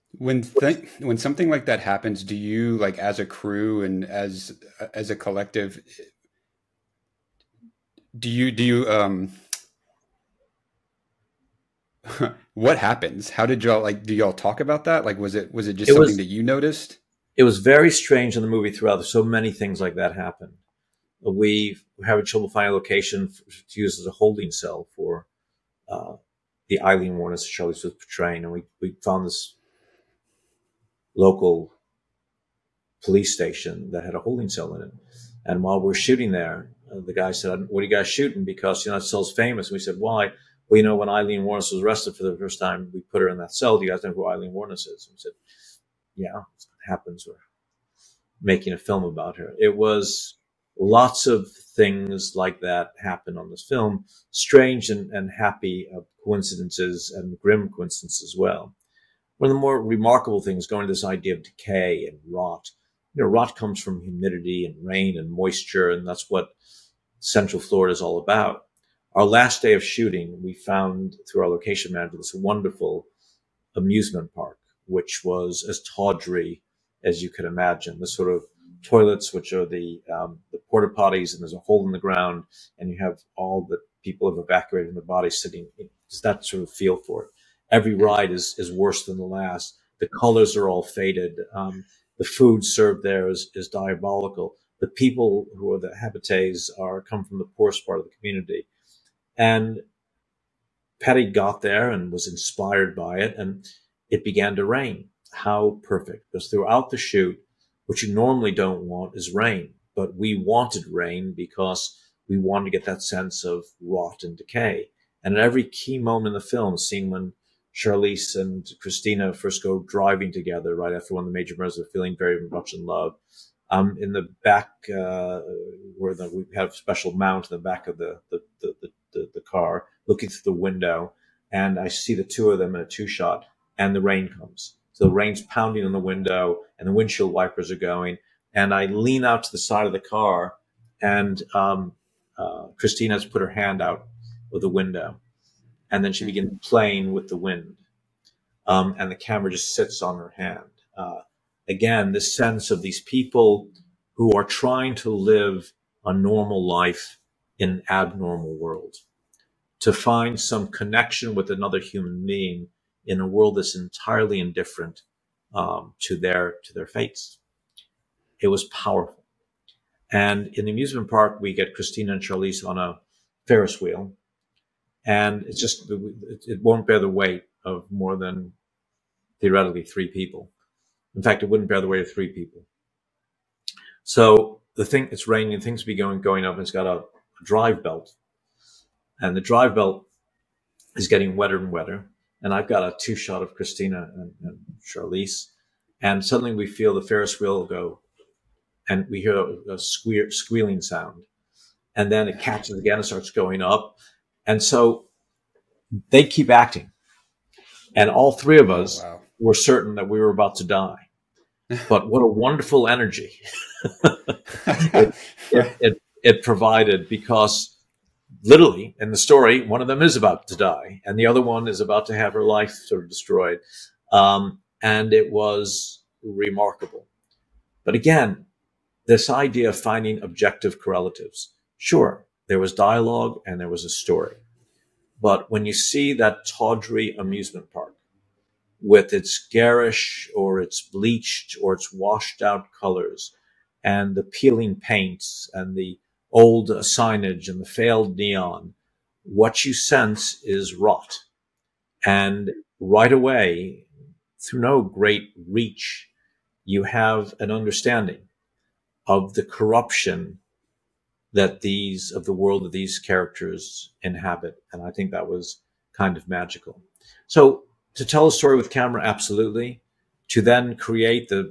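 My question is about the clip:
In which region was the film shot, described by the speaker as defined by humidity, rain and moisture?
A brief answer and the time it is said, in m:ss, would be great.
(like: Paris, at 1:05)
Central Florida, at 1:07.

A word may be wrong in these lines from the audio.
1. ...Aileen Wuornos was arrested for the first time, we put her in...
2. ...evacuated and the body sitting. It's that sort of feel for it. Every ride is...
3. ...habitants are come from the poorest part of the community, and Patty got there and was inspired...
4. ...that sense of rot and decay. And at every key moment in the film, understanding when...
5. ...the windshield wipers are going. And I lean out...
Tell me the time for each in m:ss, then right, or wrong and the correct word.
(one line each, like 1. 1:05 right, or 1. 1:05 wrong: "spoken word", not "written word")
1. 0:41 right
2. 1:24 right
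3. 1:35 right
4. 1:52 wrong: "seeing", not "understanding"
5. 2:16 right.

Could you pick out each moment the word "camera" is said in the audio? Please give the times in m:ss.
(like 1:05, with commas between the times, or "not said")
2:29, 4:28.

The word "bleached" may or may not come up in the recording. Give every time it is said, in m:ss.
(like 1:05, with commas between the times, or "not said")
4:00.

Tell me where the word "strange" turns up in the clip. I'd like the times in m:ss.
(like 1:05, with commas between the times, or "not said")
0:17, 0:54.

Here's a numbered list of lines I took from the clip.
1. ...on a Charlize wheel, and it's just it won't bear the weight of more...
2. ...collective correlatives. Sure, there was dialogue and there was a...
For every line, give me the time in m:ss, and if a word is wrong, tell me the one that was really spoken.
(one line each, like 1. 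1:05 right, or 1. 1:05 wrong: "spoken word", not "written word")
1. 2:52 wrong: "Ferris", not "Charlize"
2. 3:50 wrong: "objective", not "collective".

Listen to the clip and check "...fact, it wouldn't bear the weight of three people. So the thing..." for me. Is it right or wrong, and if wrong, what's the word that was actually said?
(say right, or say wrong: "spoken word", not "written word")
right.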